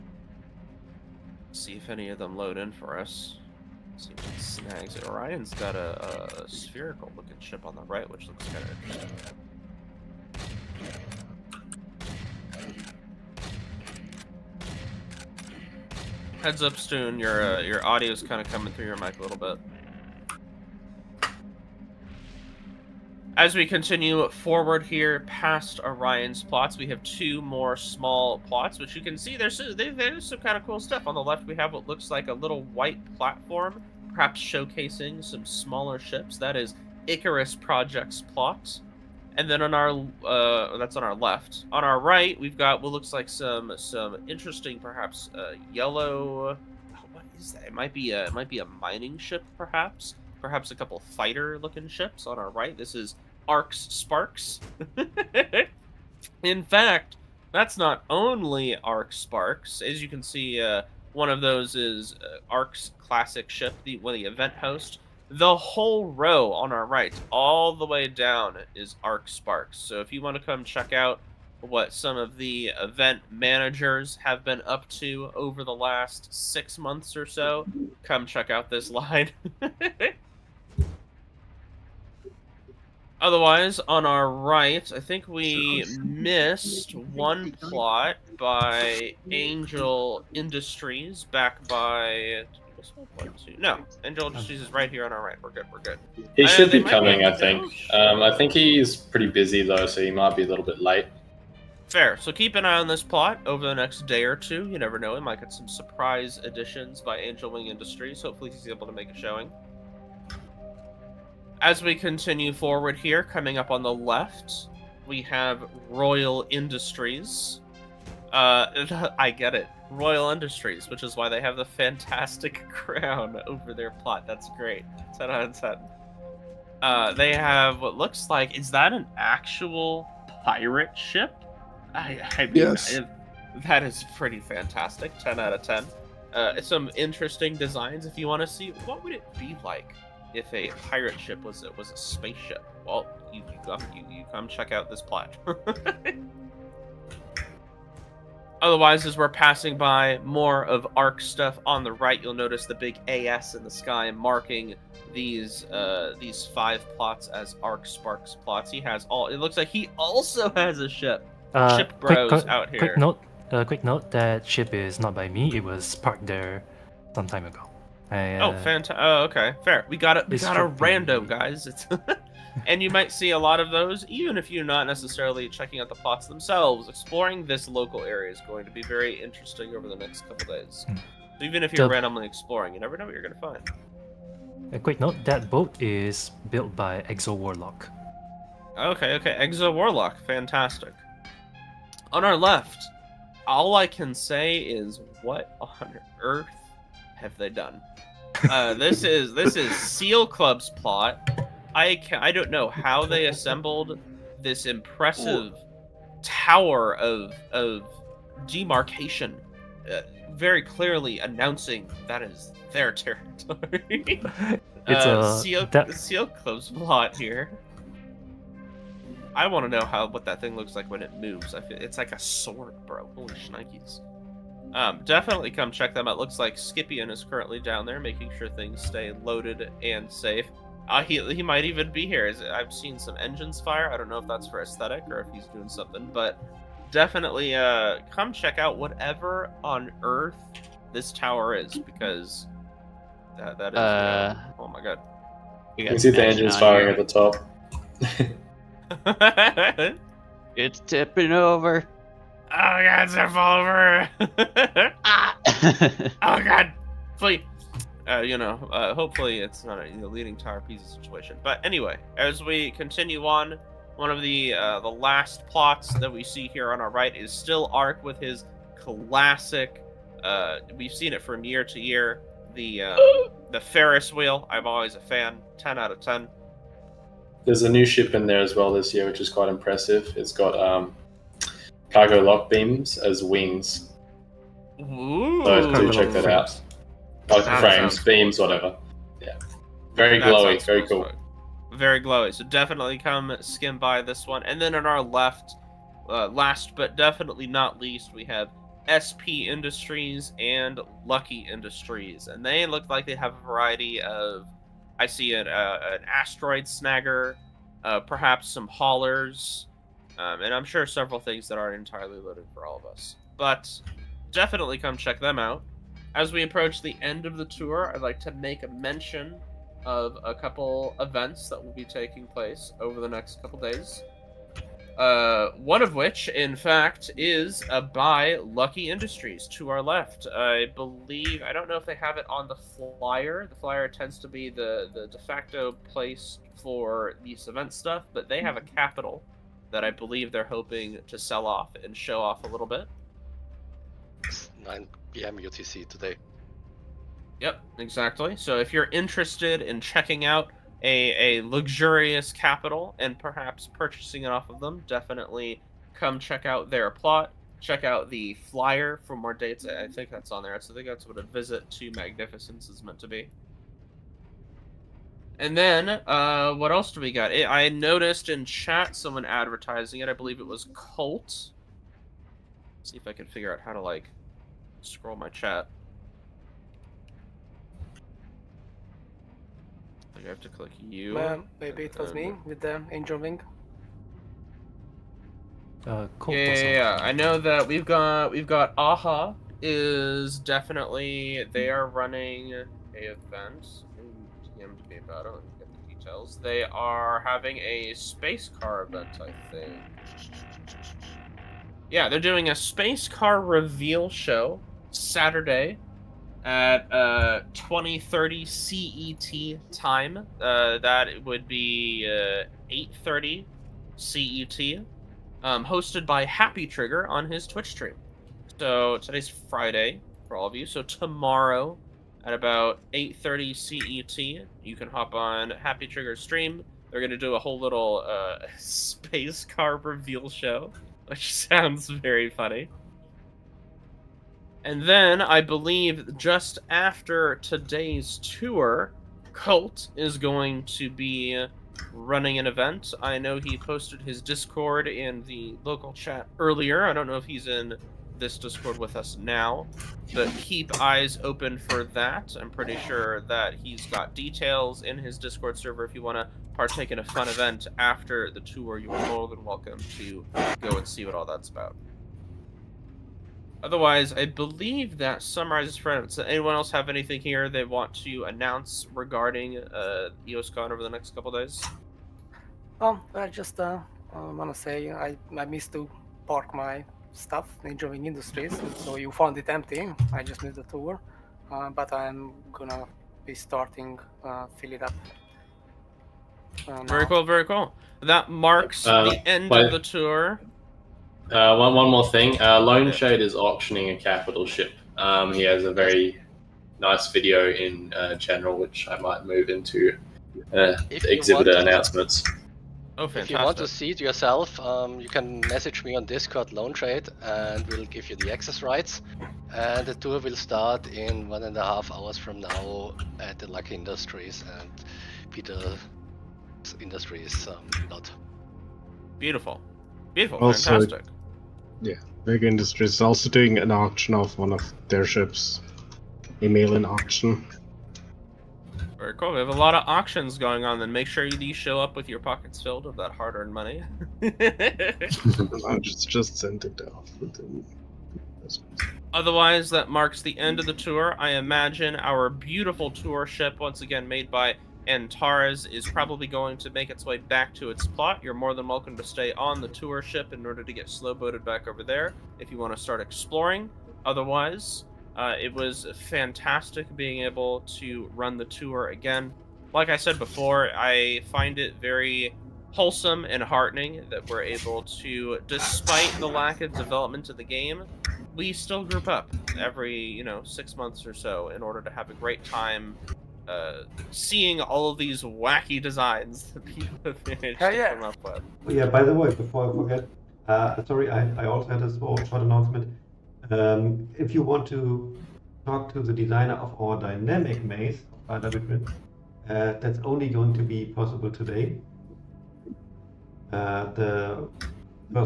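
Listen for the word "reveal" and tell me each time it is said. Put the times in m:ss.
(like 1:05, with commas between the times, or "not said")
6:43, 7:09.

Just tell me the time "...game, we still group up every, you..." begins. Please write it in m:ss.
9:27.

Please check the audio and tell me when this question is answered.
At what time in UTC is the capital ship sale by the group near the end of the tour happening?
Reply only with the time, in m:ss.
5:44.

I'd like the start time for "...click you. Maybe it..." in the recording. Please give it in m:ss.
6:20.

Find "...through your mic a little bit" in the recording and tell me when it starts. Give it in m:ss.
0:18.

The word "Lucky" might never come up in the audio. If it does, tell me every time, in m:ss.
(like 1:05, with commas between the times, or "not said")
5:01, 5:28, 8:33.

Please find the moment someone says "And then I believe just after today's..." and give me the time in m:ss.
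7:14.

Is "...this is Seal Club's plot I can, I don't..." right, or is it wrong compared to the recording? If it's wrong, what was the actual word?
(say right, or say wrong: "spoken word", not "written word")
right.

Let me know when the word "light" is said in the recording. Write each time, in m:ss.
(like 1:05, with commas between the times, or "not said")
not said.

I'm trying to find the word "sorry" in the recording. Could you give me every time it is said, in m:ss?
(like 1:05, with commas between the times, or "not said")
9:40.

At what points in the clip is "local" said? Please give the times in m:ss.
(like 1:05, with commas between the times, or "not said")
2:57, 7:25.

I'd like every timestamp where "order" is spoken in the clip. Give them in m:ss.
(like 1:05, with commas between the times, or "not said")
9:10, 9:31.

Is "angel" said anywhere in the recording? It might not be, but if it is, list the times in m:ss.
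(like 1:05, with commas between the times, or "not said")
1:29, 1:34, 1:47, 6:22.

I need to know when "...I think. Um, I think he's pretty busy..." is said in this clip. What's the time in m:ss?
1:37.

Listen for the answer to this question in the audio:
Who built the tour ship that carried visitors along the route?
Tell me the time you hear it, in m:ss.
9:04.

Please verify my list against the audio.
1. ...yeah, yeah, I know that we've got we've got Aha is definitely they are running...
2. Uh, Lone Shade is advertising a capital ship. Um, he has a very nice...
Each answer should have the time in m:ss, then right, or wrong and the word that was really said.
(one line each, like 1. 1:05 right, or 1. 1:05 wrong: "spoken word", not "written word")
1. 6:26 right
2. 8:12 wrong: "auctioning", not "advertising".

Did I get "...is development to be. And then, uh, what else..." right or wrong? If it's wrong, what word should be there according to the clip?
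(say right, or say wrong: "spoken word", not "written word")
wrong: "meant", not "development".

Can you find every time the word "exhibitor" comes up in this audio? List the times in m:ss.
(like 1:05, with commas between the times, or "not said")
8:20.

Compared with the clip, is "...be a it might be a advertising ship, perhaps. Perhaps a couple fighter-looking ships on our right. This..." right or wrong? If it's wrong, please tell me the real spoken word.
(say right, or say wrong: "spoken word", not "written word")
wrong: "mining", not "advertising".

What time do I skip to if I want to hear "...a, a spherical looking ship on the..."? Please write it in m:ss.
0:05.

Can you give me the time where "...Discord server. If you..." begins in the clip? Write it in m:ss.
7:35.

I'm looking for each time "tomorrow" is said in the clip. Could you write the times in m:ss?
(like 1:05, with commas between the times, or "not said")
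7:00.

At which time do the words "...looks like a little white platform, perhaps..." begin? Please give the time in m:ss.
0:31.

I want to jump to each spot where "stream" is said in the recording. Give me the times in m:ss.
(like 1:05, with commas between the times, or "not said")
6:57, 7:06.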